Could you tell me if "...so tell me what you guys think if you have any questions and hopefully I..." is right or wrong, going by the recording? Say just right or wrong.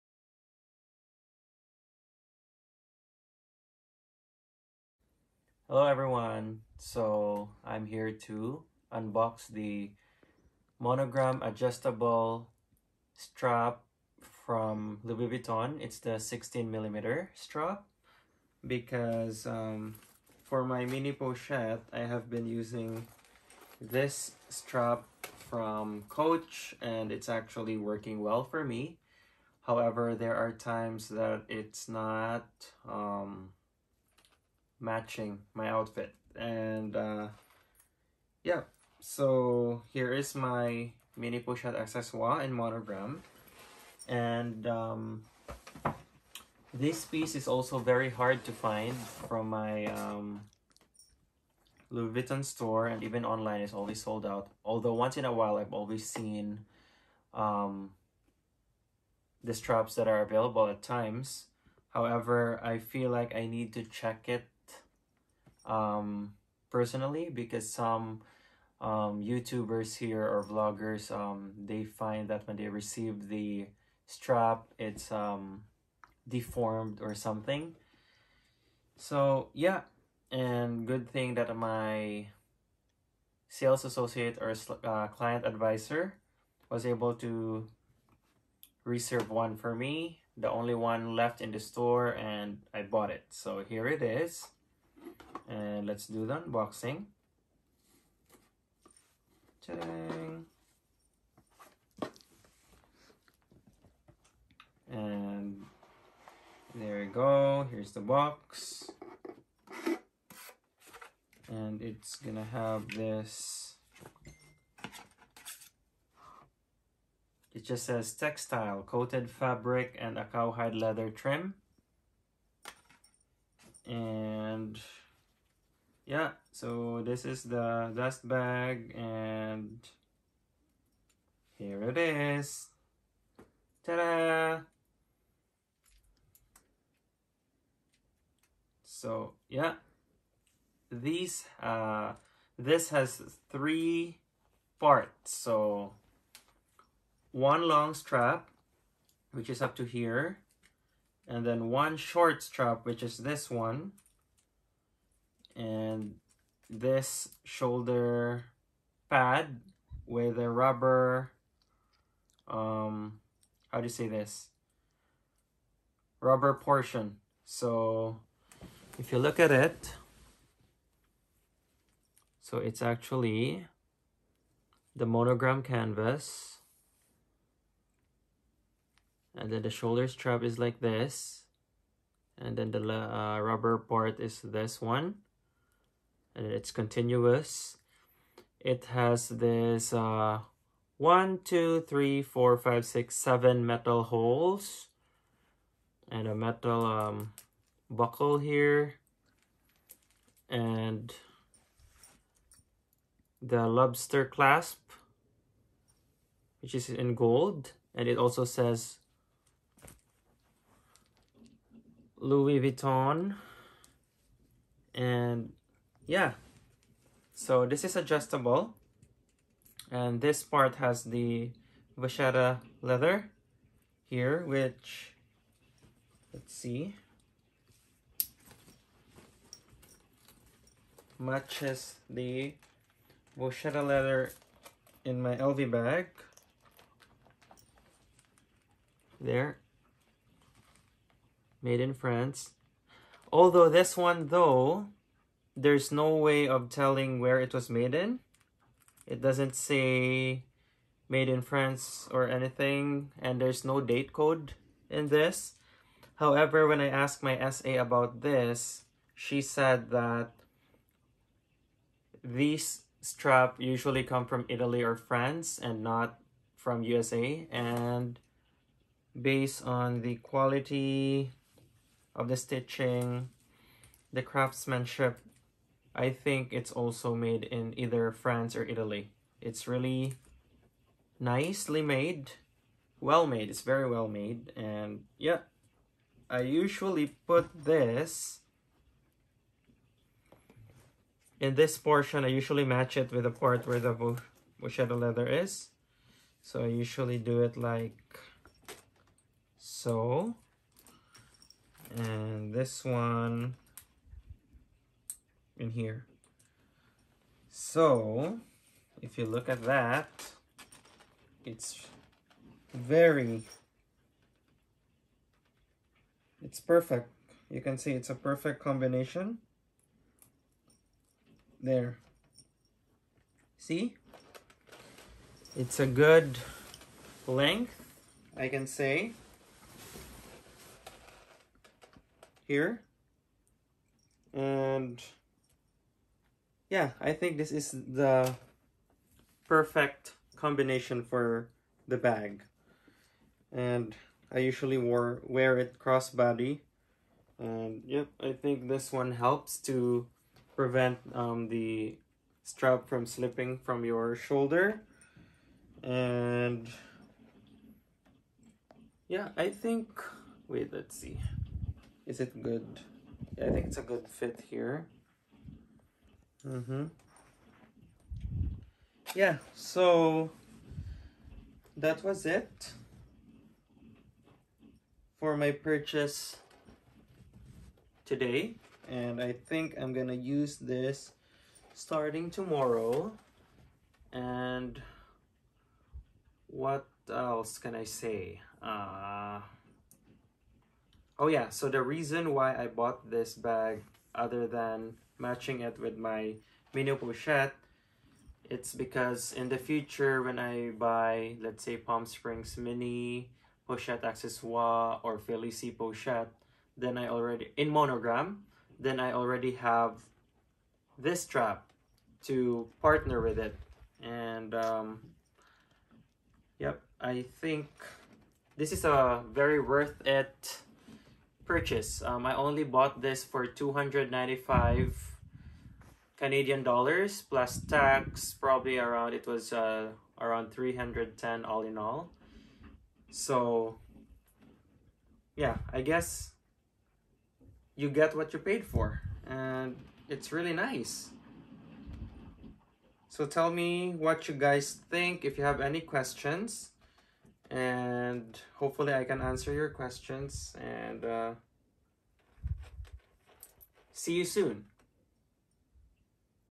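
right.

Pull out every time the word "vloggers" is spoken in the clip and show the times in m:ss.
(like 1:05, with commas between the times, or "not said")
1:10.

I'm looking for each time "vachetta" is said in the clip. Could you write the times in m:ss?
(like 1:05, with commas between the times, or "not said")
3:41, 3:53, 4:54.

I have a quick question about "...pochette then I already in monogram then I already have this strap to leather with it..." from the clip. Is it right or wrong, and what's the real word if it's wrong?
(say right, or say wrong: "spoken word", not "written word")
wrong: "partner", not "leather".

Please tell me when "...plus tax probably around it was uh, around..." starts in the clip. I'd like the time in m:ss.
7:07.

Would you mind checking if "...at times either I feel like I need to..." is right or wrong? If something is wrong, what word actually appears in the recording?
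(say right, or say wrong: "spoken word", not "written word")
wrong: "however", not "either".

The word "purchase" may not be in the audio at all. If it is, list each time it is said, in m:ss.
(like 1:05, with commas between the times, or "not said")
6:15, 7:01.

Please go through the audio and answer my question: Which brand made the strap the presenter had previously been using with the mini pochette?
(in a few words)
Coach.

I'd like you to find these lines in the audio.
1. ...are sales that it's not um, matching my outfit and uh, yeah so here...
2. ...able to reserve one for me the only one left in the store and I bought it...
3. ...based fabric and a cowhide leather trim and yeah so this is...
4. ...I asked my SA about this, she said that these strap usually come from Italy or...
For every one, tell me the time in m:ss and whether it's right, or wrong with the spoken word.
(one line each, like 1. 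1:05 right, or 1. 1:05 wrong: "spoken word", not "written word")
1. 0:30 wrong: "times", not "sales"
2. 1:26 right
3. 1:58 wrong: "coated", not "based"
4. 4:16 right.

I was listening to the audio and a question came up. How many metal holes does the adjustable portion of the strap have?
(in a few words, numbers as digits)
7.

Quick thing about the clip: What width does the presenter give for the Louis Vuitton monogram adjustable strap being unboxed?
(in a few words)
16 millimeter.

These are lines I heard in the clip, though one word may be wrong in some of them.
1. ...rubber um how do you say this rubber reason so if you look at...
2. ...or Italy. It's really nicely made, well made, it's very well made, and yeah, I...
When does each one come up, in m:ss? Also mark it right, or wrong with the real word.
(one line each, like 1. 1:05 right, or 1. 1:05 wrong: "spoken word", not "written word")
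1. 2:40 wrong: "portion", not "reason"
2. 4:38 right.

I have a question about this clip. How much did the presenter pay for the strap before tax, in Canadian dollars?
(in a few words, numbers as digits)
295.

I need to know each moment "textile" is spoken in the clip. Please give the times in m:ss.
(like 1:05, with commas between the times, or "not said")
1:58.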